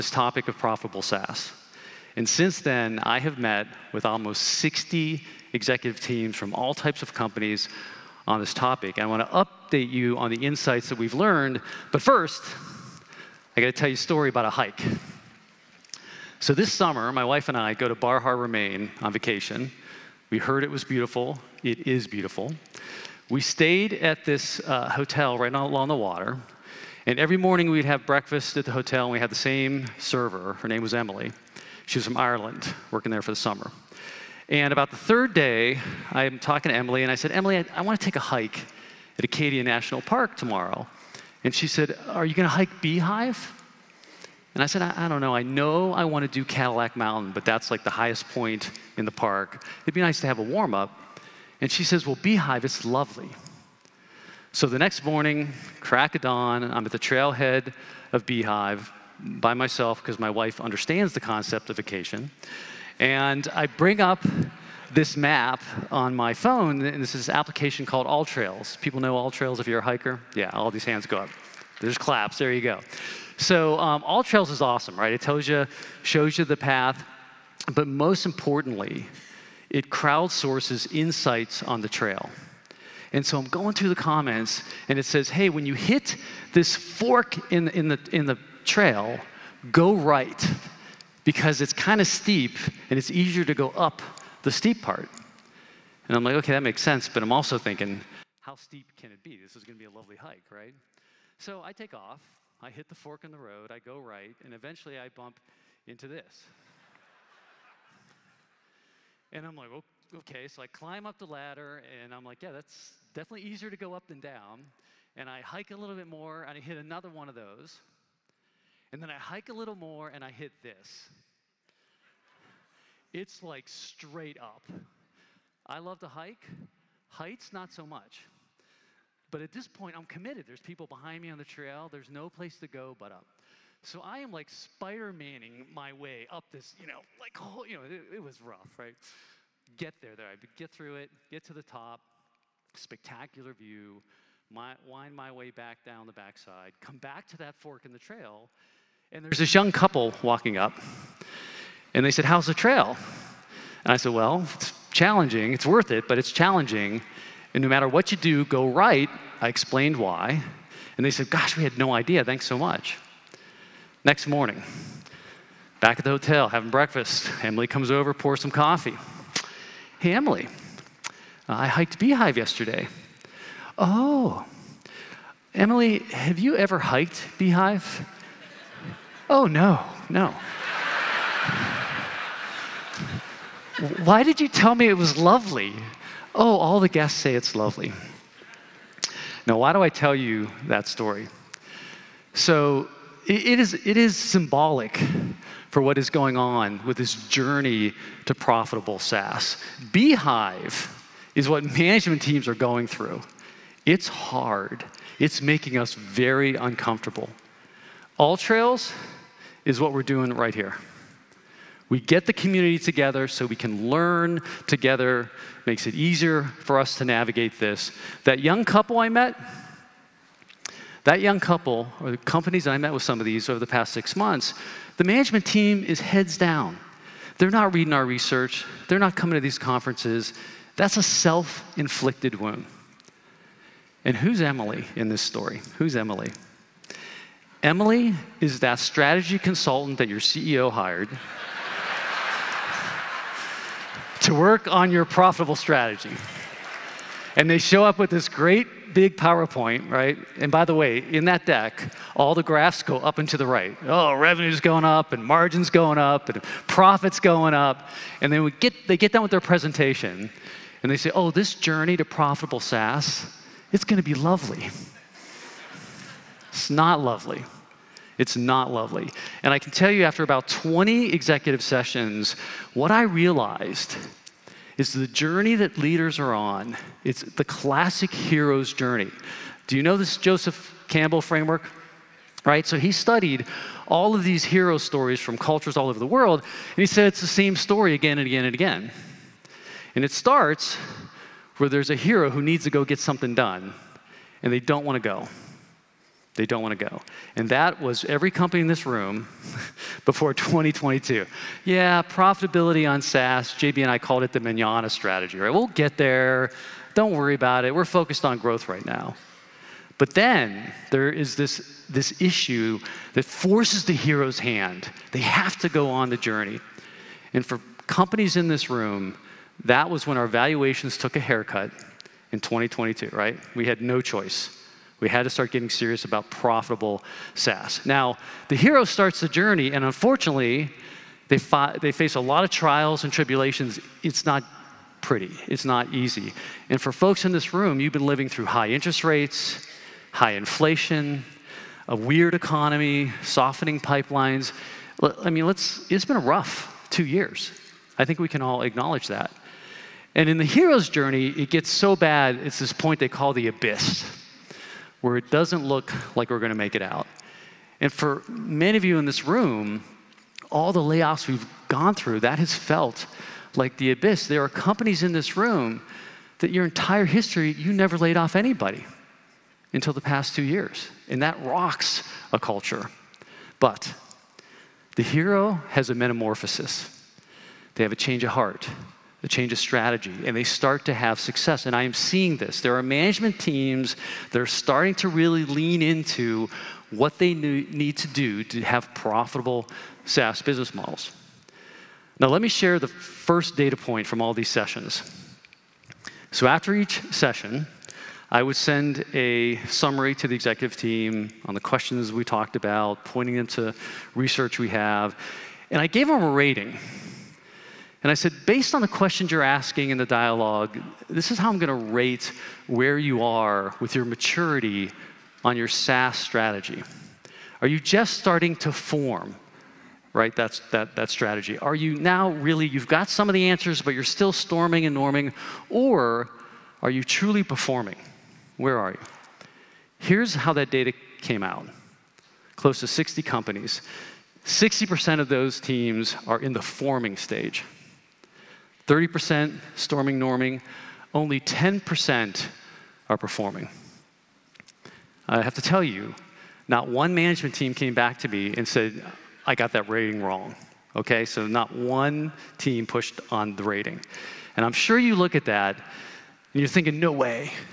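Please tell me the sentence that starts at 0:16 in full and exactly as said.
So this summer, my wife and I go to Bar Harbor, Maine on vacation.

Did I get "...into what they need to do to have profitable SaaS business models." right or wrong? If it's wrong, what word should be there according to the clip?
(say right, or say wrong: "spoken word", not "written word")
right.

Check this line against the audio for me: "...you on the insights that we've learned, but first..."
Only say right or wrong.
right.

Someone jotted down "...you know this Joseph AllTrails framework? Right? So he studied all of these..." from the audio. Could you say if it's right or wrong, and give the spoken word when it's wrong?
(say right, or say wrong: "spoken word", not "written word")
wrong: "Campbell", not "AllTrails".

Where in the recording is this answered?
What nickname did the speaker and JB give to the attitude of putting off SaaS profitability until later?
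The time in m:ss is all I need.
5:04.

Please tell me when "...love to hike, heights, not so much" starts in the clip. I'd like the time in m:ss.
2:05.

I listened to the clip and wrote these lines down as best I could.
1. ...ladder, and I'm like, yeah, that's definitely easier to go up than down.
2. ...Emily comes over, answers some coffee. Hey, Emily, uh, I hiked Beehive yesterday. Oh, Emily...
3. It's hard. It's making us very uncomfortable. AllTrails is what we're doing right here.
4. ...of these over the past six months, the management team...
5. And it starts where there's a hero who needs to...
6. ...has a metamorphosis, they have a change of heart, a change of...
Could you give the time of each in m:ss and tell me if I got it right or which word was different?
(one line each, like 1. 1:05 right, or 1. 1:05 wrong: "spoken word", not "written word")
1. 1:51 right
2. 2:47 wrong: "pours", not "answers"
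3. 3:23 right
4. 3:43 right
5. 4:49 right
6. 6:15 right.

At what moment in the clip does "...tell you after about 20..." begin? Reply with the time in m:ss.
4:29.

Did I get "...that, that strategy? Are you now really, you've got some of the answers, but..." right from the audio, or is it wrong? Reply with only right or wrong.
right.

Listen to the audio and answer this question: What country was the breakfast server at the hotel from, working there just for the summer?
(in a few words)
Ireland.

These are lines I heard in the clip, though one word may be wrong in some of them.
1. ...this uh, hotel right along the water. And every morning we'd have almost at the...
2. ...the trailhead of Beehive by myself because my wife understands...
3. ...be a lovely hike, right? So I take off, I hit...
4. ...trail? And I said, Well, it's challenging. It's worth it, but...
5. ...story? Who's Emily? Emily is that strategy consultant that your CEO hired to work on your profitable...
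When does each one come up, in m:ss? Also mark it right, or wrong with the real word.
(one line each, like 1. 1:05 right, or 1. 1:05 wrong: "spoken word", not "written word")
1. 0:24 wrong: "breakfast", not "almost"
2. 0:56 right
3. 1:39 right
4. 2:32 right
5. 3:55 right.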